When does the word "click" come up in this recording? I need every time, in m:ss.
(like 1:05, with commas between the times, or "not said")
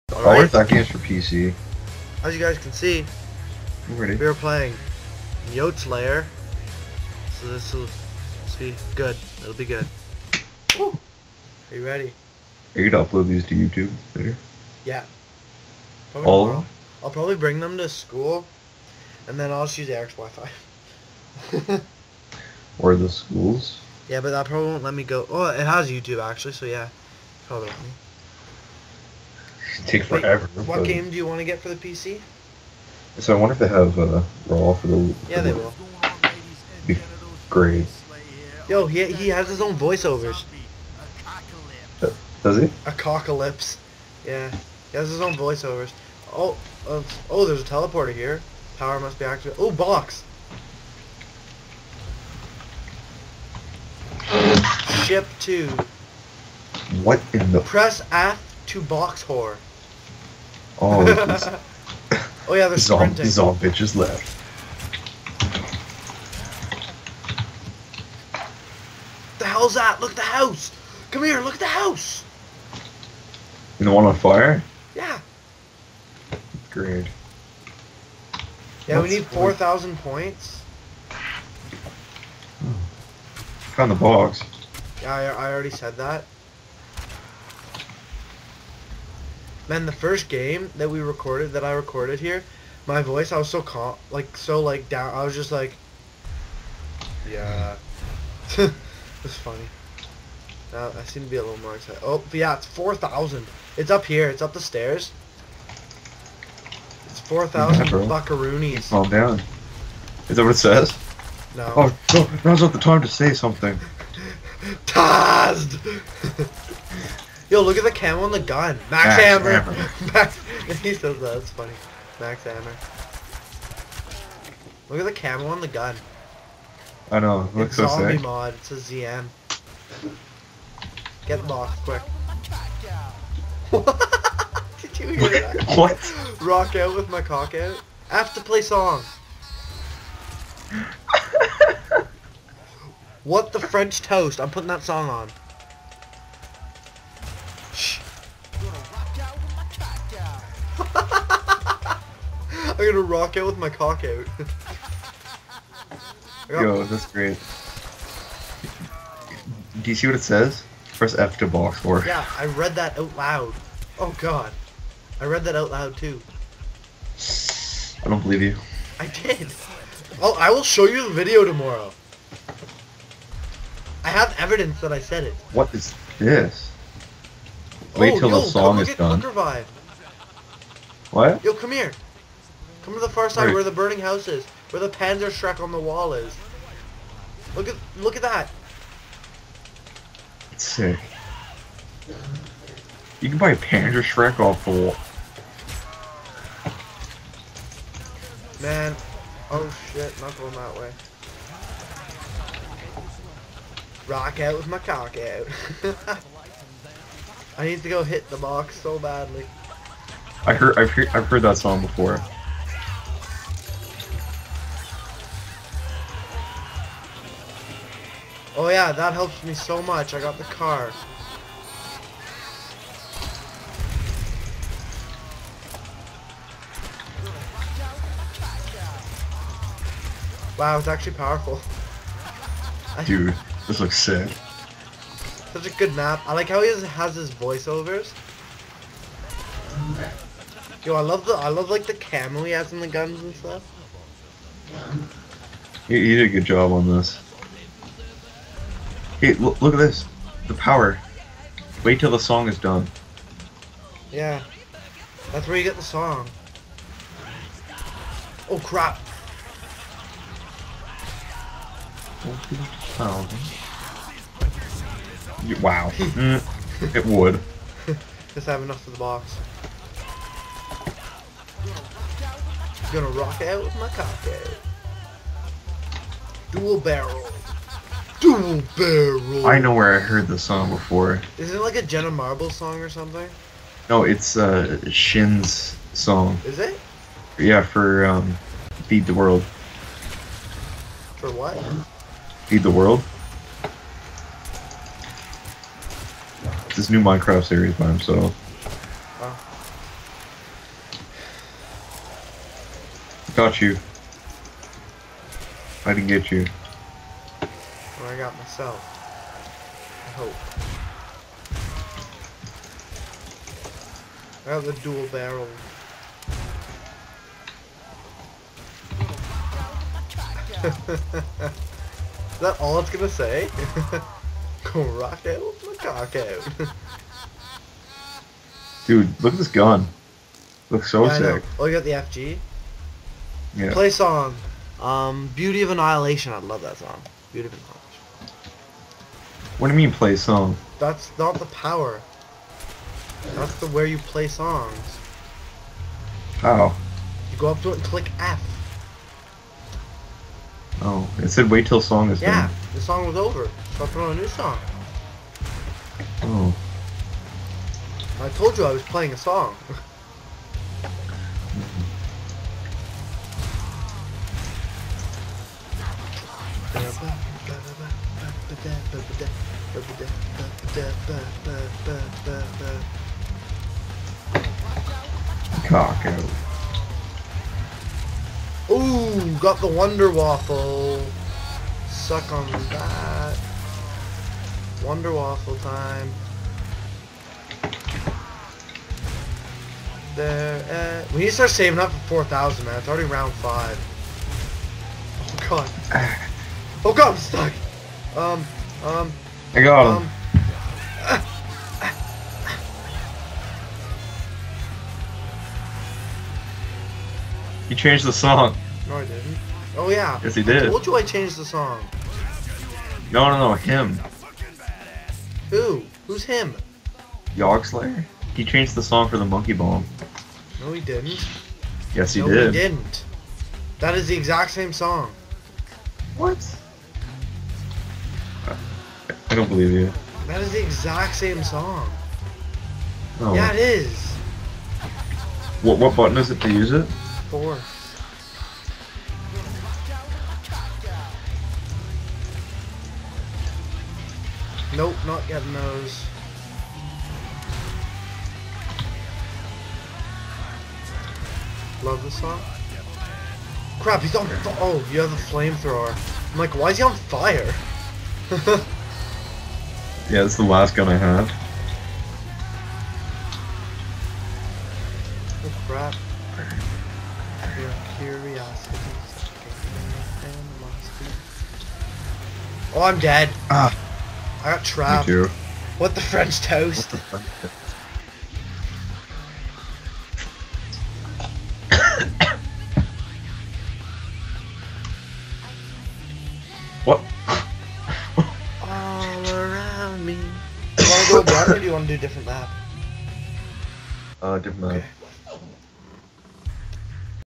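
5:47.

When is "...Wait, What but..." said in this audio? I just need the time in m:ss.
0:30.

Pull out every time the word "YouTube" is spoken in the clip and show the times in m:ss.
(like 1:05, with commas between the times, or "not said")
0:13, 0:25.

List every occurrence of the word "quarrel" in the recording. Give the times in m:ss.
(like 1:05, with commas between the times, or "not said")
not said.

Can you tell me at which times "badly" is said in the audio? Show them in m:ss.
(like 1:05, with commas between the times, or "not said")
3:28.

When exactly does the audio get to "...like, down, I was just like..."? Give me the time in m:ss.
1:34.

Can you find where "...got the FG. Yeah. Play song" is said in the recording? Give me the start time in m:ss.
5:31.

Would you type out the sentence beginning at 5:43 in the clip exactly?
That's the where you play songs.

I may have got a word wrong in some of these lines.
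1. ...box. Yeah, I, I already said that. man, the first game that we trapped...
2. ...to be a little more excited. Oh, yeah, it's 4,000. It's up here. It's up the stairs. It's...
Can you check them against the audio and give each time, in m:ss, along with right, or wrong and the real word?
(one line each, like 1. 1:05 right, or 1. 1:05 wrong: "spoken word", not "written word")
1. 1:23 wrong: "recorded", not "trapped"
2. 1:41 right.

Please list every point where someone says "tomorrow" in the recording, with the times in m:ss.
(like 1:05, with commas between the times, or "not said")
0:16, 2:51.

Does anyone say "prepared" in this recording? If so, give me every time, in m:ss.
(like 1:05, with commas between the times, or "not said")
not said.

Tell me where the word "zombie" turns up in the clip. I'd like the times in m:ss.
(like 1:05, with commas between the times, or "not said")
2:07.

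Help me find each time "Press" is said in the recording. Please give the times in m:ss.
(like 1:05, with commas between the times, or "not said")
0:57, 2:40.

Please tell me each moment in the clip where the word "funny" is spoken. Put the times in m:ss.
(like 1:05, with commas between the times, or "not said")
1:39, 2:01.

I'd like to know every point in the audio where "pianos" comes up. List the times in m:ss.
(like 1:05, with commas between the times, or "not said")
not said.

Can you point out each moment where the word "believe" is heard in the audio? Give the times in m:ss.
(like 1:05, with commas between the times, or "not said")
2:48, 7:09.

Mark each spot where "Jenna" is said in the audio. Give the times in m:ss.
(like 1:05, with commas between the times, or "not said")
4:41.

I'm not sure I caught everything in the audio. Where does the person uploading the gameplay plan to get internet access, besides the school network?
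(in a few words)
Eric's Wi-Fi.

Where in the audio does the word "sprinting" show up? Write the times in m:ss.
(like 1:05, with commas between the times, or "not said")
1:02.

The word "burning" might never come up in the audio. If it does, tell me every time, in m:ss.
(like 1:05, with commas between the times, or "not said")
3:03.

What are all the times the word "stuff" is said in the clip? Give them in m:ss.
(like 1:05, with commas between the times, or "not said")
4:03.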